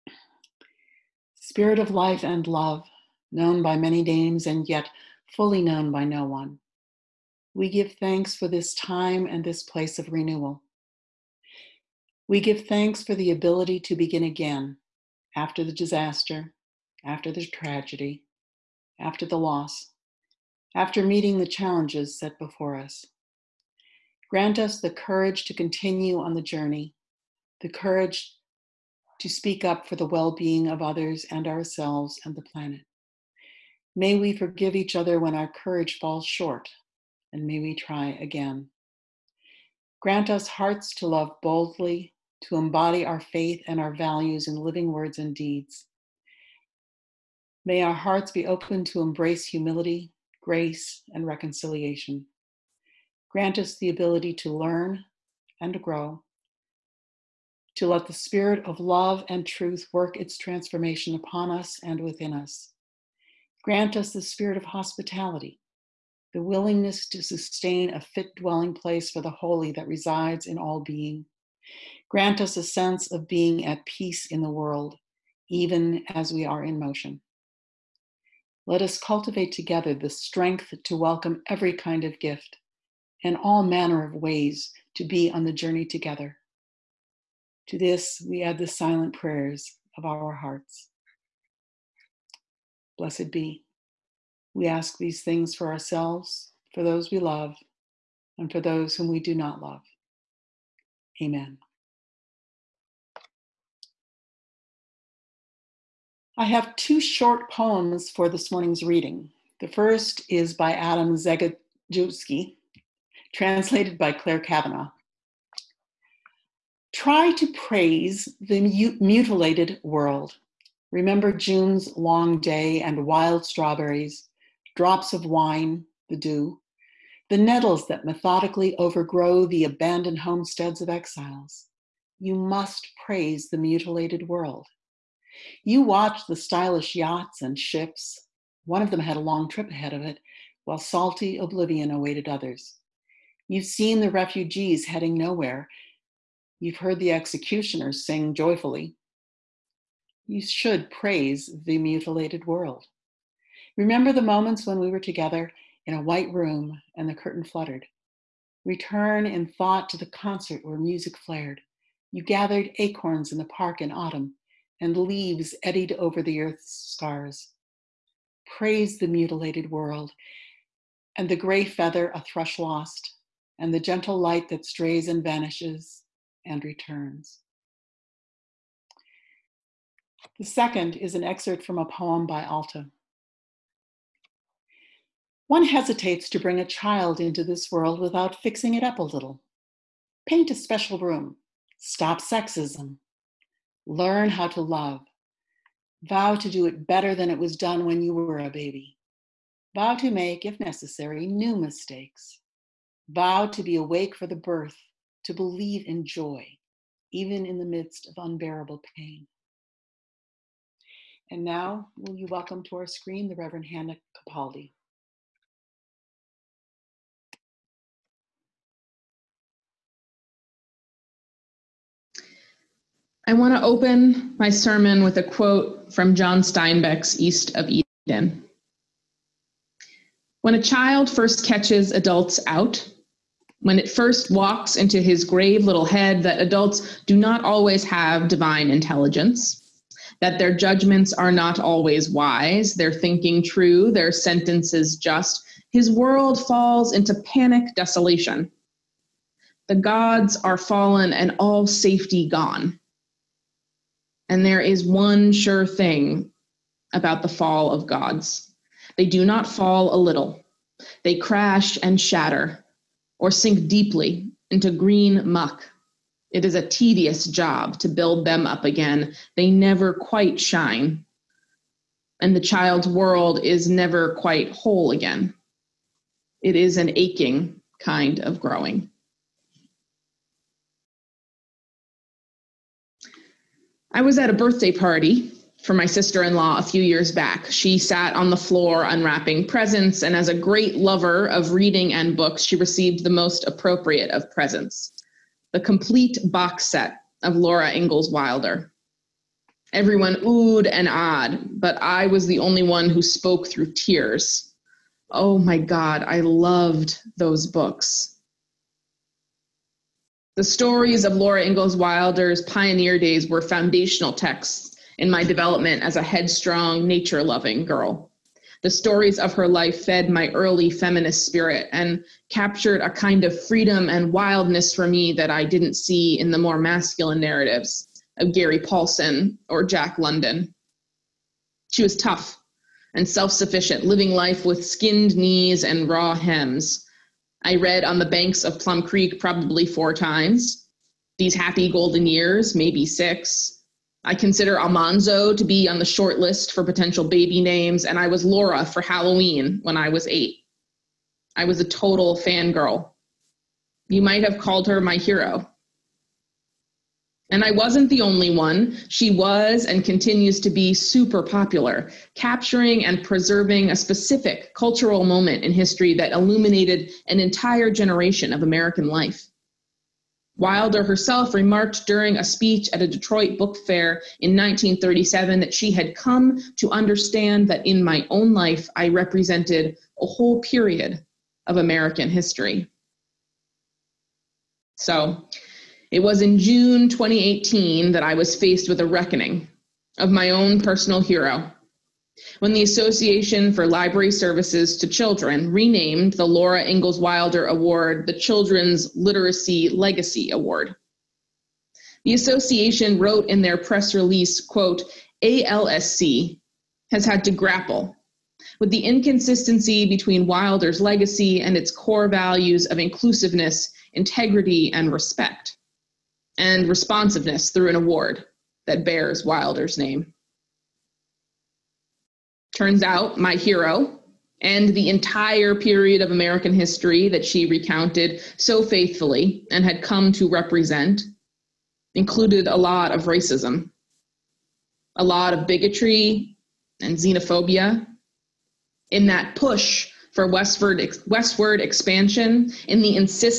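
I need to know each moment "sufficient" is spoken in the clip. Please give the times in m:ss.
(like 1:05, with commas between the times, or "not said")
5:33.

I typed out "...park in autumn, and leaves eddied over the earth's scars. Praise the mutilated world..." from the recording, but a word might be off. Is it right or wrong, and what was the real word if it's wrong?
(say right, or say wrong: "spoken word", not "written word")
right.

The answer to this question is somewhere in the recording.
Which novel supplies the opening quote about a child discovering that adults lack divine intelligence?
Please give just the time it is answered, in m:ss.
3:47.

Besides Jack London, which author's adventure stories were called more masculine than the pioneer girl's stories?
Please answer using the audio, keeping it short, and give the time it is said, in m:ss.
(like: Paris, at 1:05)
Gary Paulsen, at 5:28.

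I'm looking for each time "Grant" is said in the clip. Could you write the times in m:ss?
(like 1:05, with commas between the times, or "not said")
0:24, 0:40, 0:53, 1:03, 1:12.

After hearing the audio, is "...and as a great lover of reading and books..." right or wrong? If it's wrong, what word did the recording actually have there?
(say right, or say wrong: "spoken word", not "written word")
right.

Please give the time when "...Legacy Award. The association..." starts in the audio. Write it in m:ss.
6:39.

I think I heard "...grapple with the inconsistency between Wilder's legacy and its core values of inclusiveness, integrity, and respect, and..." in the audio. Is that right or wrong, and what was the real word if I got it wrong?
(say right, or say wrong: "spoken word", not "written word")
right.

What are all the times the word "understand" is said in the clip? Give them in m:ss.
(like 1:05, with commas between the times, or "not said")
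6:16.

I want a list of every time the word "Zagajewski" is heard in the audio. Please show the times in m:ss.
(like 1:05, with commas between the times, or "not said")
1:51.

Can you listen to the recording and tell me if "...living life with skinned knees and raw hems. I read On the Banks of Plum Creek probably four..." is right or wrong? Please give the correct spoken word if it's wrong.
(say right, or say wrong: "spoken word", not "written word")
right.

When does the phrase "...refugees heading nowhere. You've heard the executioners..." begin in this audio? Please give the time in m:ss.
2:24.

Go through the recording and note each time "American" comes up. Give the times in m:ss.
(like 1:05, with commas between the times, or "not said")
6:08, 6:21, 7:06.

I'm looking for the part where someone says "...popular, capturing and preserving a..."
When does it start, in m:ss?
6:01.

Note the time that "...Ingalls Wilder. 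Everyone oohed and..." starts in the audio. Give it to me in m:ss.
4:57.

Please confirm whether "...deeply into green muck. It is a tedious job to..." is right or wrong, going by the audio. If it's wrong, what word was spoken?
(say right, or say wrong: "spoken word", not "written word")
right.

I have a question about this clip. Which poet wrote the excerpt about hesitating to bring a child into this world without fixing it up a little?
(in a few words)
Alta.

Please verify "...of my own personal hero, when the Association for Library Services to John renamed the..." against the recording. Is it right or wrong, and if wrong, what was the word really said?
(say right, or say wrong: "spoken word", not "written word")
wrong: "Children", not "John".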